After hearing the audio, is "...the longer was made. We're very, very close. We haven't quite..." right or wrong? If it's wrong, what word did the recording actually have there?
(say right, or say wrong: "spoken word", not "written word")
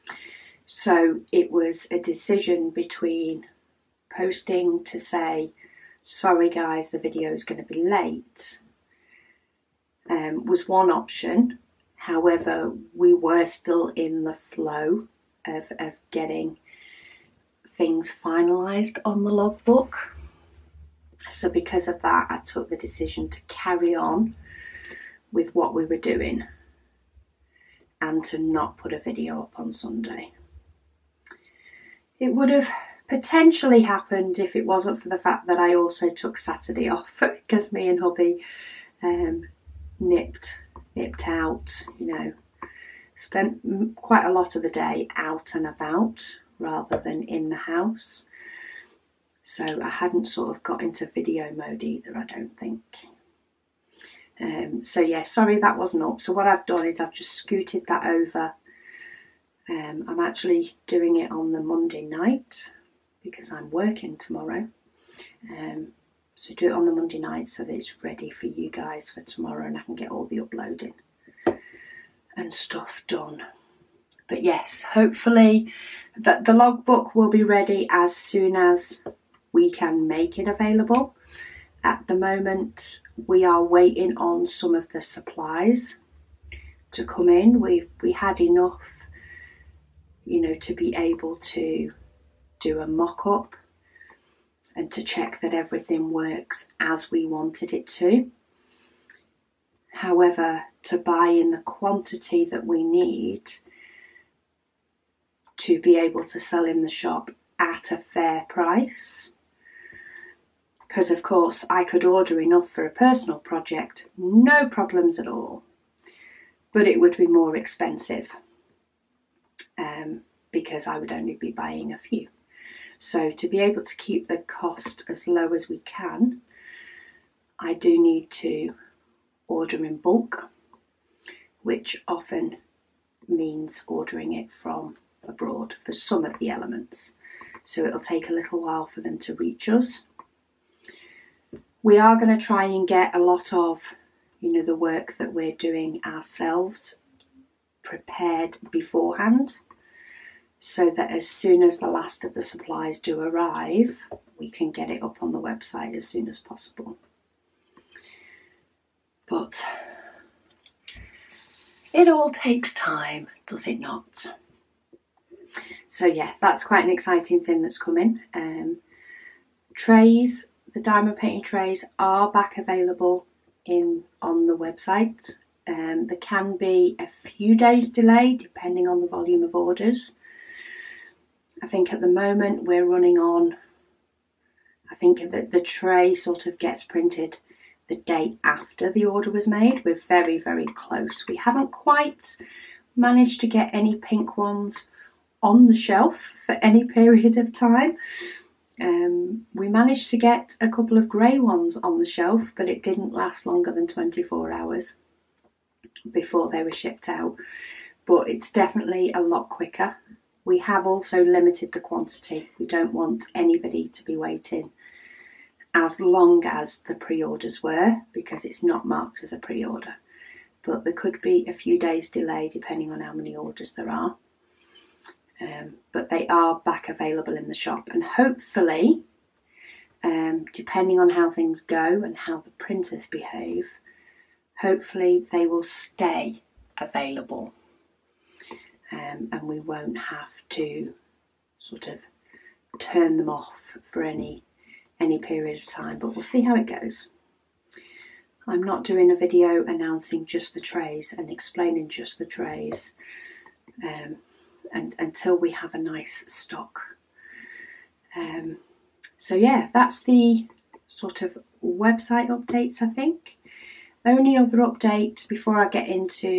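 wrong: "order", not "longer".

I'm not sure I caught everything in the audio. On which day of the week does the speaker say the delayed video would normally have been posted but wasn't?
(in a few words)
Sunday.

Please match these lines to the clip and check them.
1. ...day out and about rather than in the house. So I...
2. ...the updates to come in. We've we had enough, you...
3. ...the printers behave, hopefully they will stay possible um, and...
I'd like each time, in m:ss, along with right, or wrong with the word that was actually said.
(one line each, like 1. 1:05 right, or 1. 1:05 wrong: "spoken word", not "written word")
1. 0:44 right
2. 1:24 wrong: "supplies", not "updates"
3. 3:52 wrong: "available", not "possible".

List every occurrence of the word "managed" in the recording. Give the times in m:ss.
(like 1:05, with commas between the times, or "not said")
3:12, 3:19.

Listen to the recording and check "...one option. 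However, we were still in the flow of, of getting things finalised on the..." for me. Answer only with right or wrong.
right.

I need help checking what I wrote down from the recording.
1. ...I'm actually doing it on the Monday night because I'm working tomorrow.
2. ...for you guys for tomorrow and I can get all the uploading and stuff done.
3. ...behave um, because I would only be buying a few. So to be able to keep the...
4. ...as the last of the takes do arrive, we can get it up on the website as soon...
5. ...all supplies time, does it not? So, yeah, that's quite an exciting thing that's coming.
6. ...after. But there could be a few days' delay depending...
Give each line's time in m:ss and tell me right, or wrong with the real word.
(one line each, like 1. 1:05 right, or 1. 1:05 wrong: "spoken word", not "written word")
1. 1:00 right
2. 1:08 right
3. 1:57 wrong: "expensive", not "behave"
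4. 2:31 wrong: "supplies", not "takes"
5. 2:42 wrong: "takes", not "supplies"
6. 3:39 wrong: "order", not "after".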